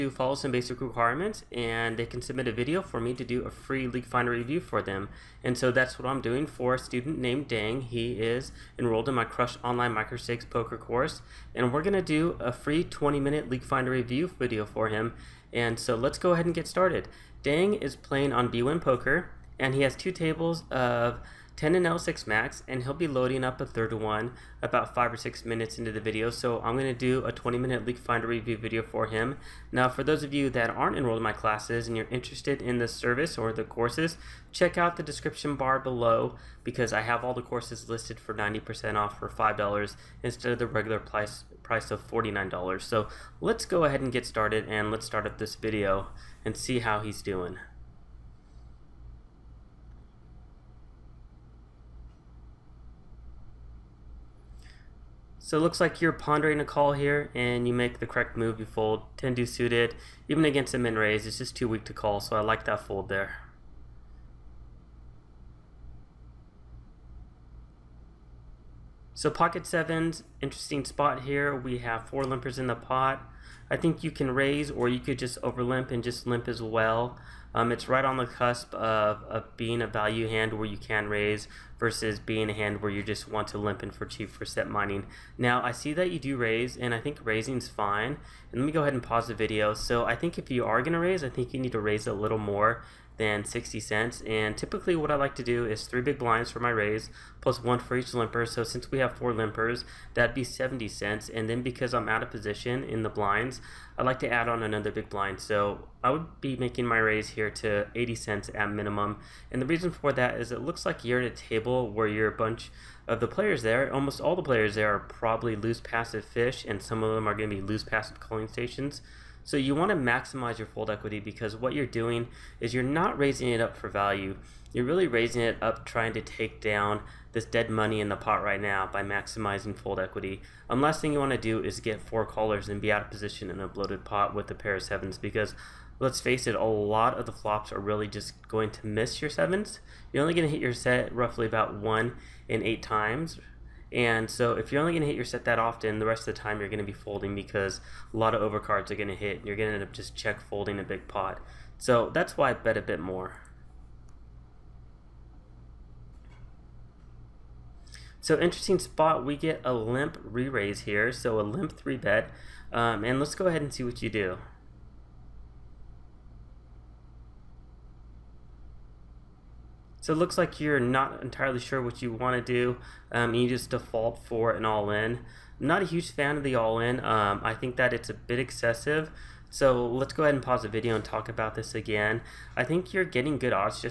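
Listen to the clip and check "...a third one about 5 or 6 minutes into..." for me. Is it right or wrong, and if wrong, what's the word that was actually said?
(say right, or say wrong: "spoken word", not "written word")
right.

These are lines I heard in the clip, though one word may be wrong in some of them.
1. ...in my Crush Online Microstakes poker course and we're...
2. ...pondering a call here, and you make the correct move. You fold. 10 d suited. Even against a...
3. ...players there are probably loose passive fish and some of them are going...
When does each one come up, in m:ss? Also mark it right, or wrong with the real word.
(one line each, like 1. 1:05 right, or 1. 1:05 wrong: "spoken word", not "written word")
1. 0:09 right
2. 0:56 right
3. 1:54 right.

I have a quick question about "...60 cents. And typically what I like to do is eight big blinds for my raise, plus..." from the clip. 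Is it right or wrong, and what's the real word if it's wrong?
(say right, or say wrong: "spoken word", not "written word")
wrong: "three", not "eight".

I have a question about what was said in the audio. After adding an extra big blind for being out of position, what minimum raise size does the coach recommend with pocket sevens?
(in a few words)
80 cents.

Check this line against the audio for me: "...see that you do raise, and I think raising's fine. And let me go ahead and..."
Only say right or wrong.
right.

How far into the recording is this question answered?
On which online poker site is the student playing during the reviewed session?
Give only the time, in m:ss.
0:18.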